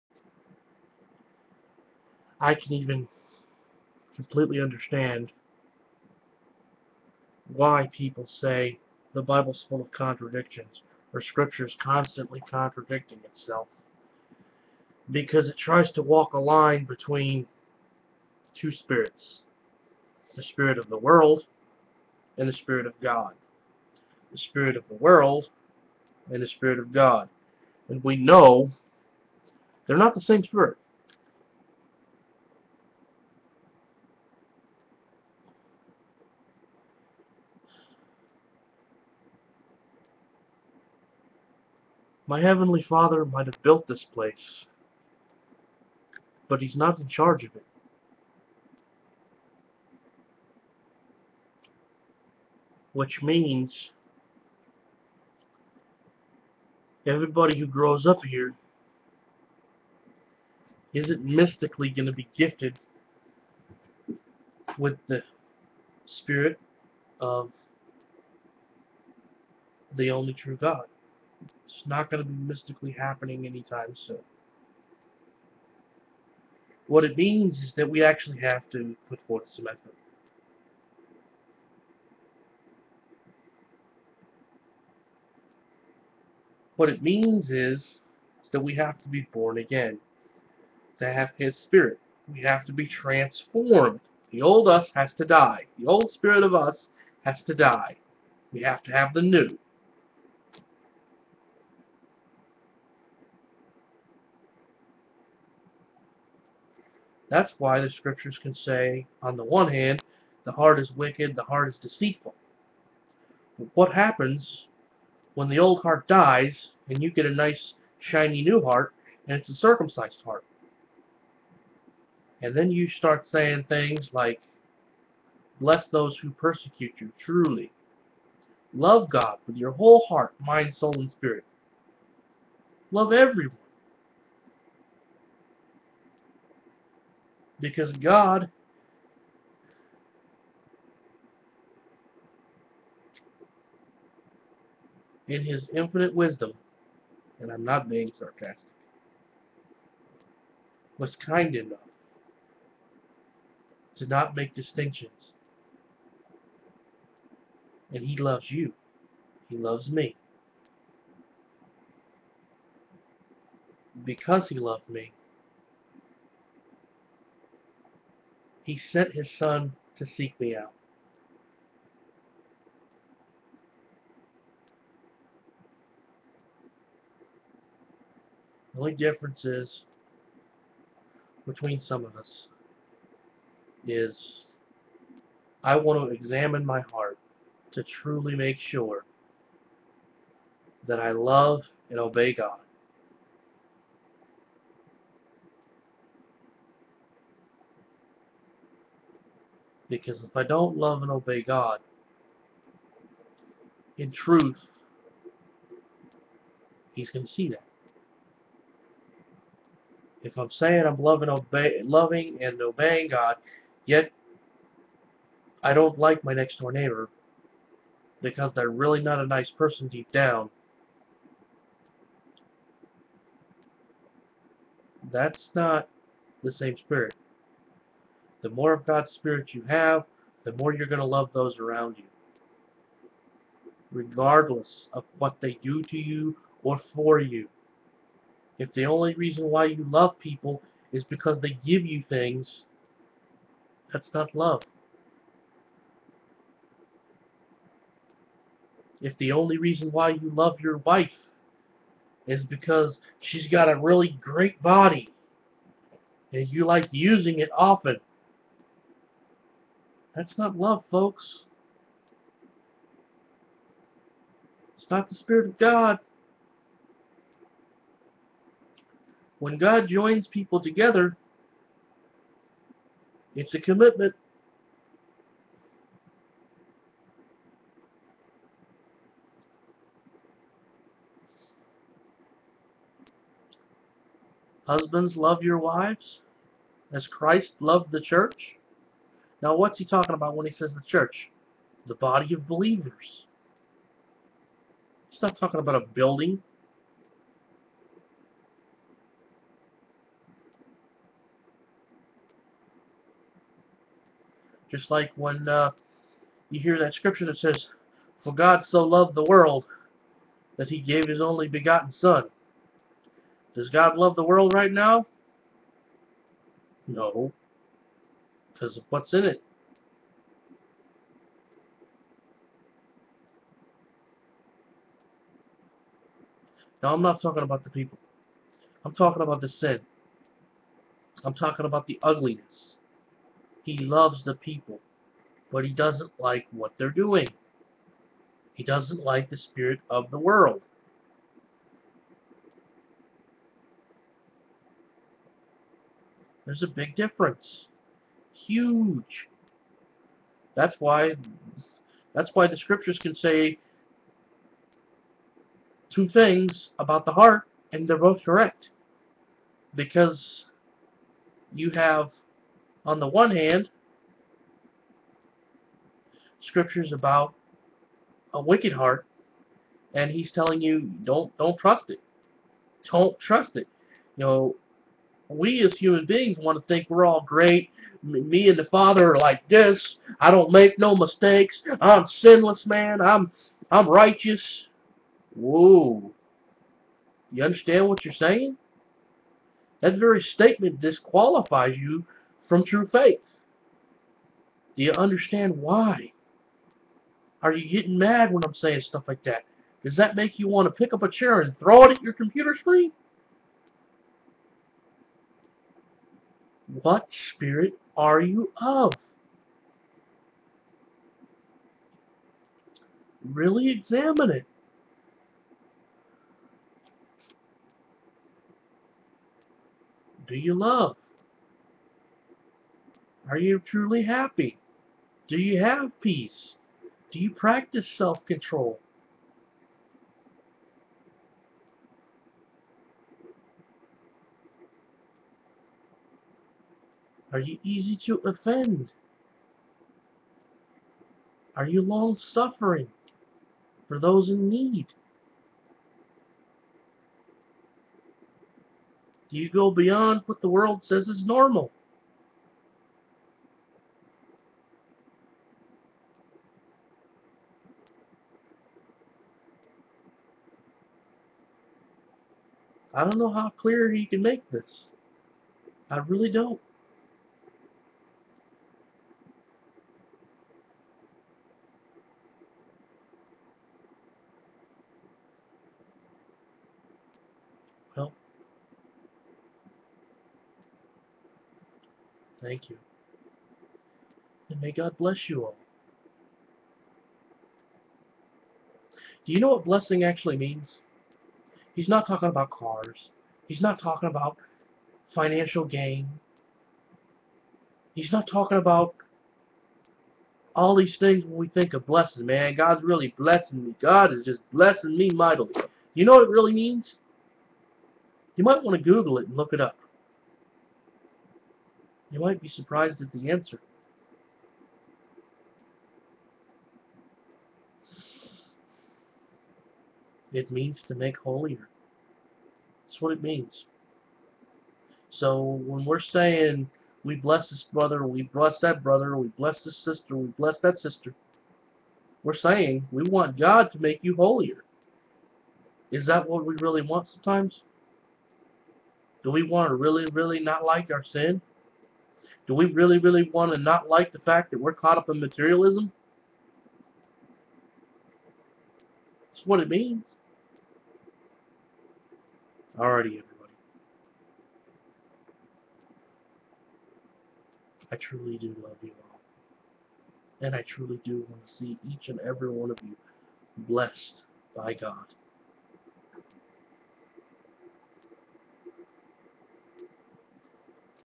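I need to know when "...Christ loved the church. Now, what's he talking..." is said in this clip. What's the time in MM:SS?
04:47.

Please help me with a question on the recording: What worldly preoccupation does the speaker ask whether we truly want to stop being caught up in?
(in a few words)
Materialism.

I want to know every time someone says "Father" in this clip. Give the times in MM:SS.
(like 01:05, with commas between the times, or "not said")
00:42, 06:18.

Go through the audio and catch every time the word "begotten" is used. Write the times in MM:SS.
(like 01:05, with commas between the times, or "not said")
05:11.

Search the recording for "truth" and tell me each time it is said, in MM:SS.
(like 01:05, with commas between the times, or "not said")
03:24.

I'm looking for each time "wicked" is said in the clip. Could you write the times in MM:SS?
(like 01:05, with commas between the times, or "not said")
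01:50, 06:08.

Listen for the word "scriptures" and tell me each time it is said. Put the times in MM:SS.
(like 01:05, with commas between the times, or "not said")
00:11, 01:47, 05:06, 05:52, 06:06.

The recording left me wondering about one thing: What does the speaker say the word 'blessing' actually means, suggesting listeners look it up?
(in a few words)
To make holier.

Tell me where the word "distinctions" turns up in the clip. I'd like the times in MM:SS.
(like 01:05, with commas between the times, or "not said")
02:34.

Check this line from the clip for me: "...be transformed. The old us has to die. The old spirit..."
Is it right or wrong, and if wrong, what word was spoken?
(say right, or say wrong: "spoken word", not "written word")
right.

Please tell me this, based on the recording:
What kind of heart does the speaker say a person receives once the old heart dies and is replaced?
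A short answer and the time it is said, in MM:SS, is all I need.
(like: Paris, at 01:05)
A circumcised heart, at 01:59.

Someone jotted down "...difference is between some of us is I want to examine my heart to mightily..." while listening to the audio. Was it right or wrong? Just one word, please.
wrong.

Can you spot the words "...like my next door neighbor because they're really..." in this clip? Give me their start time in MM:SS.
03:35.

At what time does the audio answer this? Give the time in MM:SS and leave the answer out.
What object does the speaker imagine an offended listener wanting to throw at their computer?
06:41.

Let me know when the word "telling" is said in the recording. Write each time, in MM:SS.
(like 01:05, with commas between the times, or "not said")
06:10.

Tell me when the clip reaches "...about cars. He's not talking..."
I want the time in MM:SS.
08:12.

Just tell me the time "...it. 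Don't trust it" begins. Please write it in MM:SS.
06:11.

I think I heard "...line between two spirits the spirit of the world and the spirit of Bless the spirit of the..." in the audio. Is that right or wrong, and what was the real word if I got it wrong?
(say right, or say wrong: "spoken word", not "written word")
wrong: "God", not "Bless".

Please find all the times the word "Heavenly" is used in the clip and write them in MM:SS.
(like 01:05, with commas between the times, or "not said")
00:42.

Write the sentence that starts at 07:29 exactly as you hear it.
Do you go beyond what the world says is normal?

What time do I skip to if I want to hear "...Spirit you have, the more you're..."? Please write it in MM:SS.
03:49.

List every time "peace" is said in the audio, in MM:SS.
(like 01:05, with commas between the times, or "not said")
07:05.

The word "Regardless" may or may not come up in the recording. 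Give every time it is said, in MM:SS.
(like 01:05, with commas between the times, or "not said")
03:53.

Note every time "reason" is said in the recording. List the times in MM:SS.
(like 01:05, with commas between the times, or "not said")
03:59, 04:09.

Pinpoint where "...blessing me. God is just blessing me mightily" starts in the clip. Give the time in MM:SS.
08:23.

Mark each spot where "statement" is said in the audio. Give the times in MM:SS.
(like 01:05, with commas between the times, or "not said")
06:30.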